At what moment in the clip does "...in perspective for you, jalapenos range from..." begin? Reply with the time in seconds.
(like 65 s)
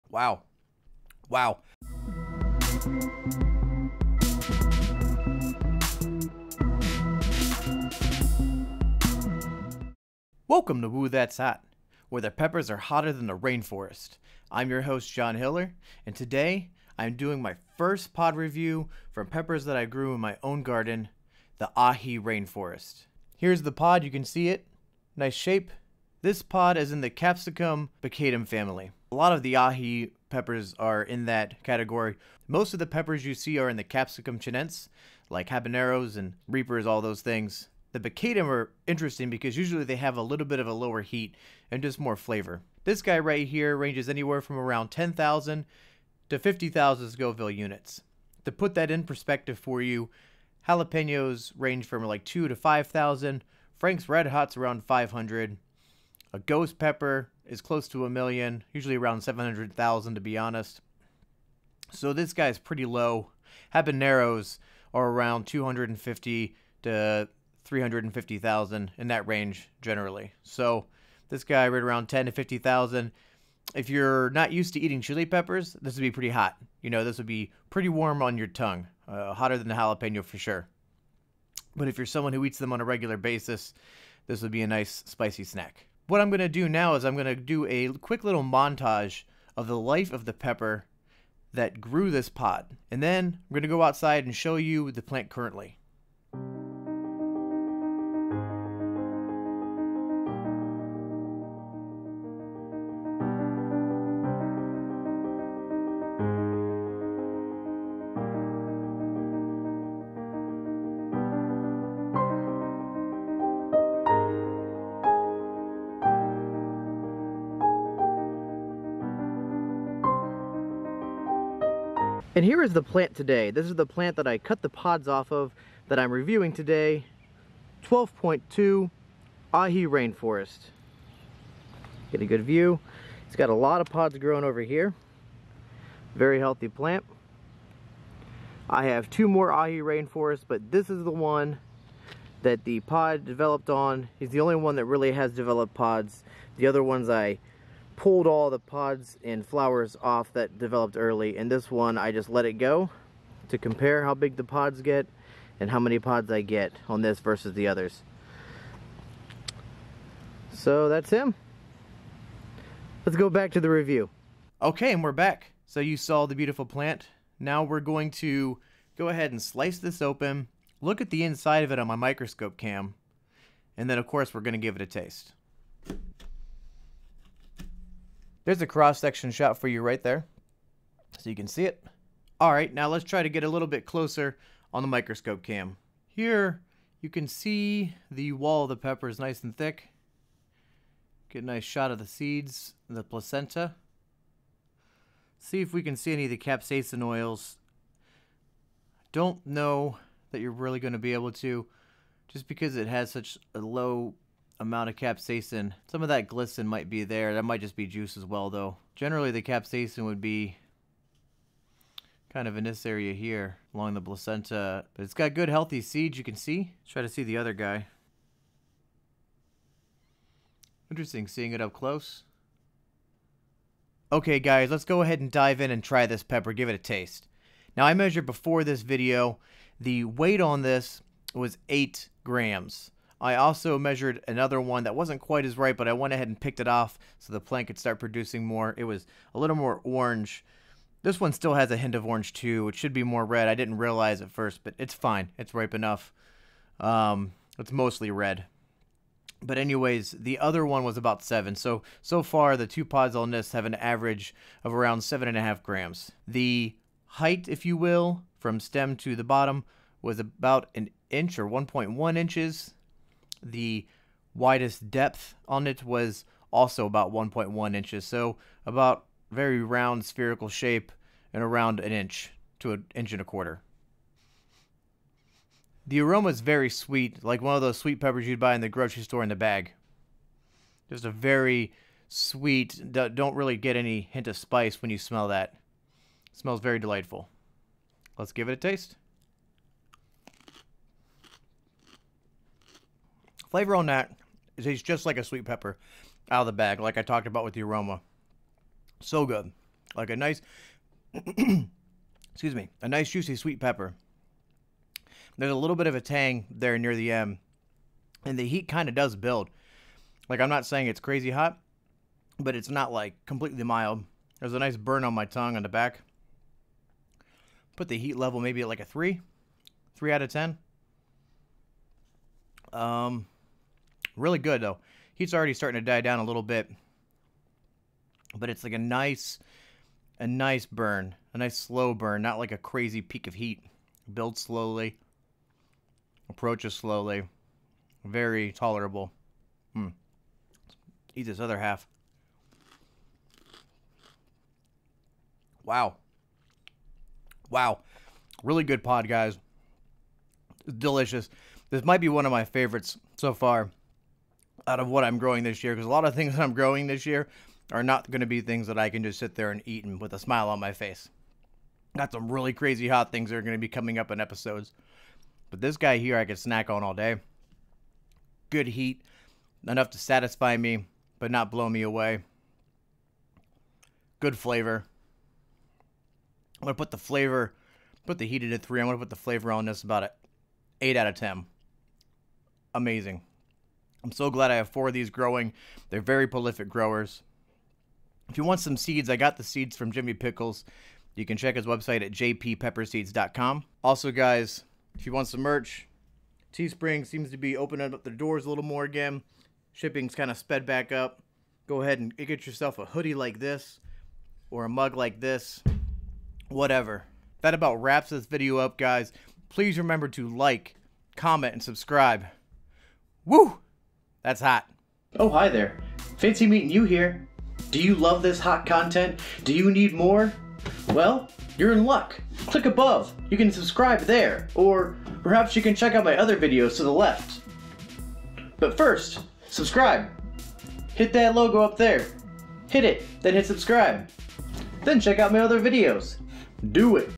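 48 s.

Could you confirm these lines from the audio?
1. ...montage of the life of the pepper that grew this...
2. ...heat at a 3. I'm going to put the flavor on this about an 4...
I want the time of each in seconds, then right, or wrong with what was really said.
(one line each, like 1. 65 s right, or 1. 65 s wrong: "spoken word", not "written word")
1. 88 s right
2. 378 s wrong: "8", not "4".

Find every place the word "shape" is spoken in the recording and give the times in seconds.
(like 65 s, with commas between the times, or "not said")
25 s, 270 s.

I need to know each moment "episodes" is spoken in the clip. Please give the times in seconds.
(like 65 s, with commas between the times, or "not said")
364 s.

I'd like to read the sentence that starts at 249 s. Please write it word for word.
But anyways, the other one was about seven.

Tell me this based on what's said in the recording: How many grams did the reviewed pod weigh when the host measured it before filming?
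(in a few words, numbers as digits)
8 grams.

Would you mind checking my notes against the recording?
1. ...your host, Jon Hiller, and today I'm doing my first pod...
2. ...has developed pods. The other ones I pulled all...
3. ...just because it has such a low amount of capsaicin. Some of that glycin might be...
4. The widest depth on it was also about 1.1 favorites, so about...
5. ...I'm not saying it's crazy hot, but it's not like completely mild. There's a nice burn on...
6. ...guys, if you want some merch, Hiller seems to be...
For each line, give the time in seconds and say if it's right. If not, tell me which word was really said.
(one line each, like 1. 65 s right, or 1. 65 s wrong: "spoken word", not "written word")
1. 14 s right
2. 145 s right
3. 202 s right
4. 263 s wrong: "inches", not "favorites"
5. 310 s right
6. 394 s wrong: "Teespring", not "Hiller".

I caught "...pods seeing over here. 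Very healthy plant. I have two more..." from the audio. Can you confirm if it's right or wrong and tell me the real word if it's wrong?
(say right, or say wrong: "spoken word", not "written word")
wrong: "growing", not "seeing".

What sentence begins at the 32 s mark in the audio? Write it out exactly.
Most of the peppers you see are in the capsicum chinense, like habaneros and reapers, all those things.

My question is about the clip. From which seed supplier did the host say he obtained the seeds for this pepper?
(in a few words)
Jimmy Pickles.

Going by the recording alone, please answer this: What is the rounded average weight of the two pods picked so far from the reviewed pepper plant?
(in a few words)
7.5 grams.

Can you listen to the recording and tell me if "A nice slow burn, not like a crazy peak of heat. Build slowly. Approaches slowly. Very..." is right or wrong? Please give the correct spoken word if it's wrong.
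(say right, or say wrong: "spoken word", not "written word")
right.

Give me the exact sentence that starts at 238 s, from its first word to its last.
It was a little more orange.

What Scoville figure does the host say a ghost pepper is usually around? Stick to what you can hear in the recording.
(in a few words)
700,000.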